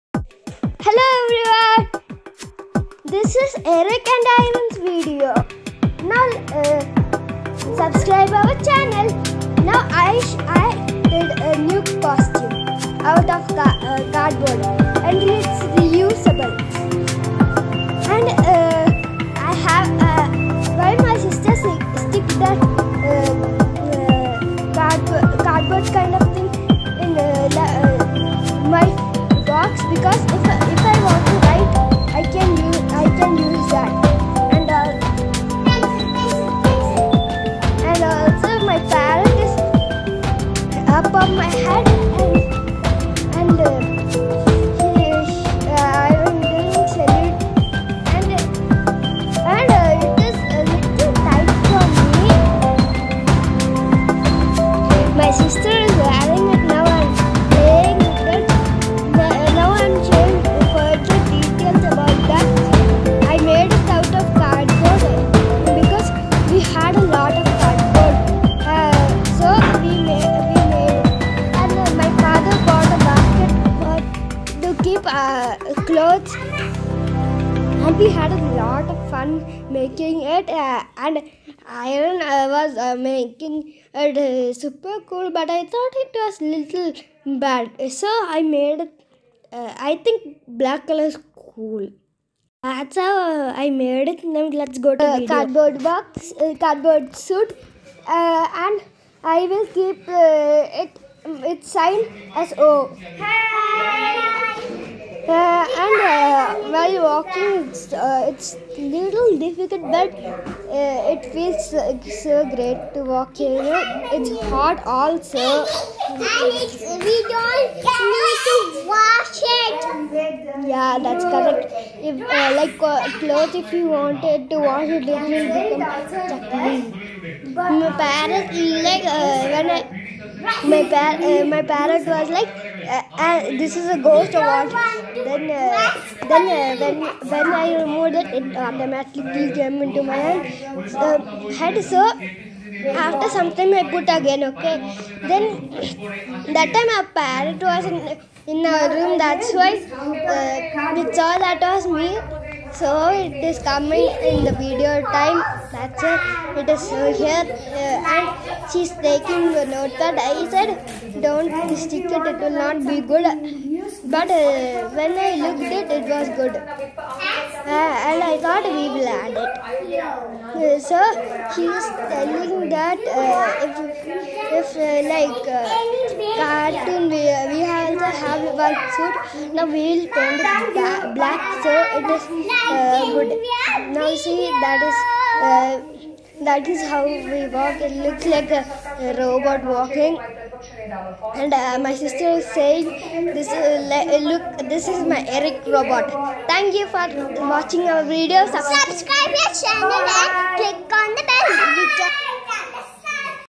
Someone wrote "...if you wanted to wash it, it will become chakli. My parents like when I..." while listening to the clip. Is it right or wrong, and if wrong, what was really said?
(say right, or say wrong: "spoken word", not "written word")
right.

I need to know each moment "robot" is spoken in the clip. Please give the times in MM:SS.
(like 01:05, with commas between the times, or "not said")
03:09, 03:15.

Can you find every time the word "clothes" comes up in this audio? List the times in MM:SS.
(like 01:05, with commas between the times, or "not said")
02:03.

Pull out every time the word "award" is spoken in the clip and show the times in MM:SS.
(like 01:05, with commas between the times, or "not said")
02:14.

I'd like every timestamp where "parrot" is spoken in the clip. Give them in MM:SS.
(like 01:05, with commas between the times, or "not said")
02:27.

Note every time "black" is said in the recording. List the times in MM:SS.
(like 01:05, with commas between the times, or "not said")
01:30, 03:01.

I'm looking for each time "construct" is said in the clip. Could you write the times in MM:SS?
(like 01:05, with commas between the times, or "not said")
not said.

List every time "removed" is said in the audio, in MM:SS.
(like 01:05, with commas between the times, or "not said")
02:17.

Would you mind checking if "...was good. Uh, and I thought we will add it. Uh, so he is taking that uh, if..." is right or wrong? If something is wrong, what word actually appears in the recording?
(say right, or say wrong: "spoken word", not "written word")
wrong: "telling", not "taking".